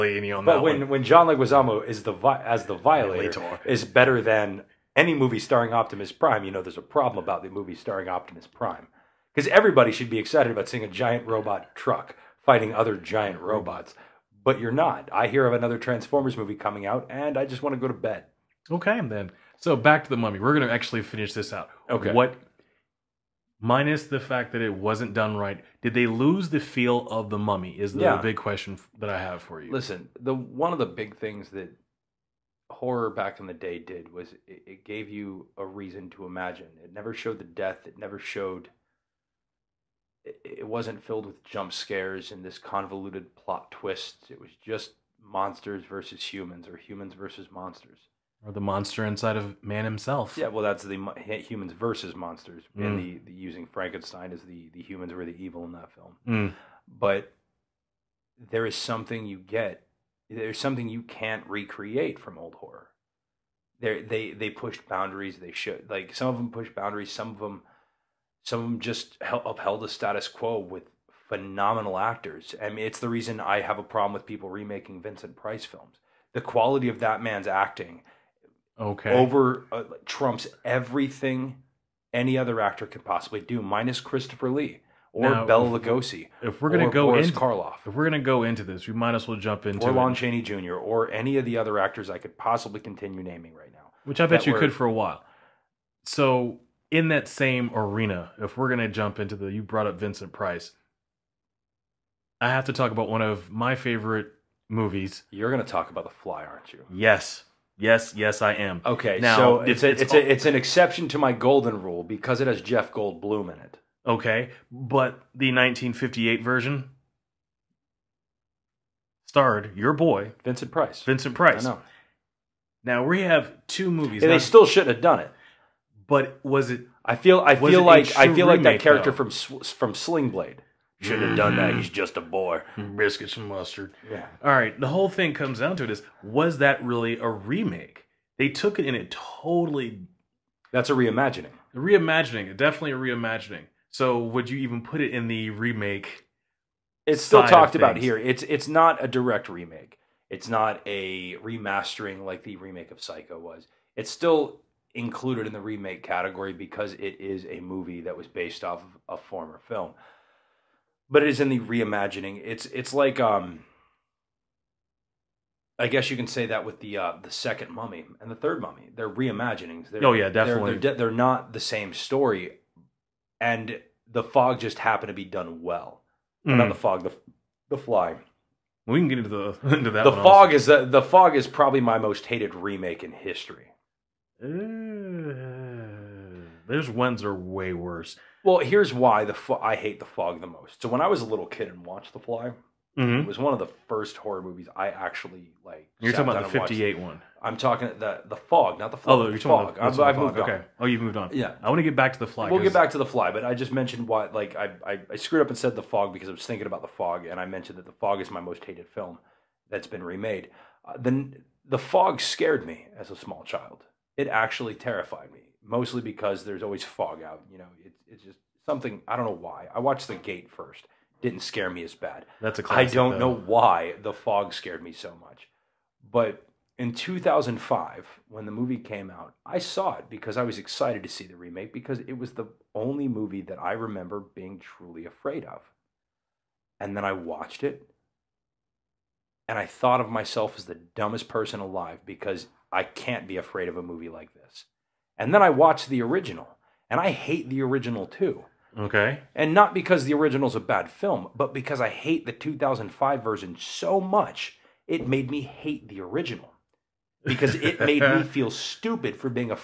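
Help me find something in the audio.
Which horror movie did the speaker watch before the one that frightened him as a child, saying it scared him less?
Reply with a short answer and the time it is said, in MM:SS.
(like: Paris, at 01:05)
The Gate, at 03:40.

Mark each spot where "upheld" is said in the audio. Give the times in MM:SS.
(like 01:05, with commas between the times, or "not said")
01:09.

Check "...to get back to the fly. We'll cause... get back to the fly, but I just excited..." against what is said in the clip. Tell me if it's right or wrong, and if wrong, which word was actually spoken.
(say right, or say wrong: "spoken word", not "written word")
wrong: "mentioned", not "excited".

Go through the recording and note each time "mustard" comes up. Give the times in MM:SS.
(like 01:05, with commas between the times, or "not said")
02:13.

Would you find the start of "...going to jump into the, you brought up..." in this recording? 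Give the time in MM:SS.
01:38.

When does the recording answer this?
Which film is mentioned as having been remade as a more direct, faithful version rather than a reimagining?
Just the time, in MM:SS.
02:33.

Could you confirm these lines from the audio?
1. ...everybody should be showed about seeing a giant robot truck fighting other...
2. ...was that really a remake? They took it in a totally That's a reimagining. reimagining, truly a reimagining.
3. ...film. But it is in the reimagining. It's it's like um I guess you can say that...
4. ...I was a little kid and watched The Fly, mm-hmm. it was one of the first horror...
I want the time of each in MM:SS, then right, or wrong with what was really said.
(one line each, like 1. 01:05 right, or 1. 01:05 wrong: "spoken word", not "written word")
1. 00:09 wrong: "excited", not "showed"
2. 02:16 wrong: "definitely", not "truly"
3. 02:39 right
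4. 03:11 right.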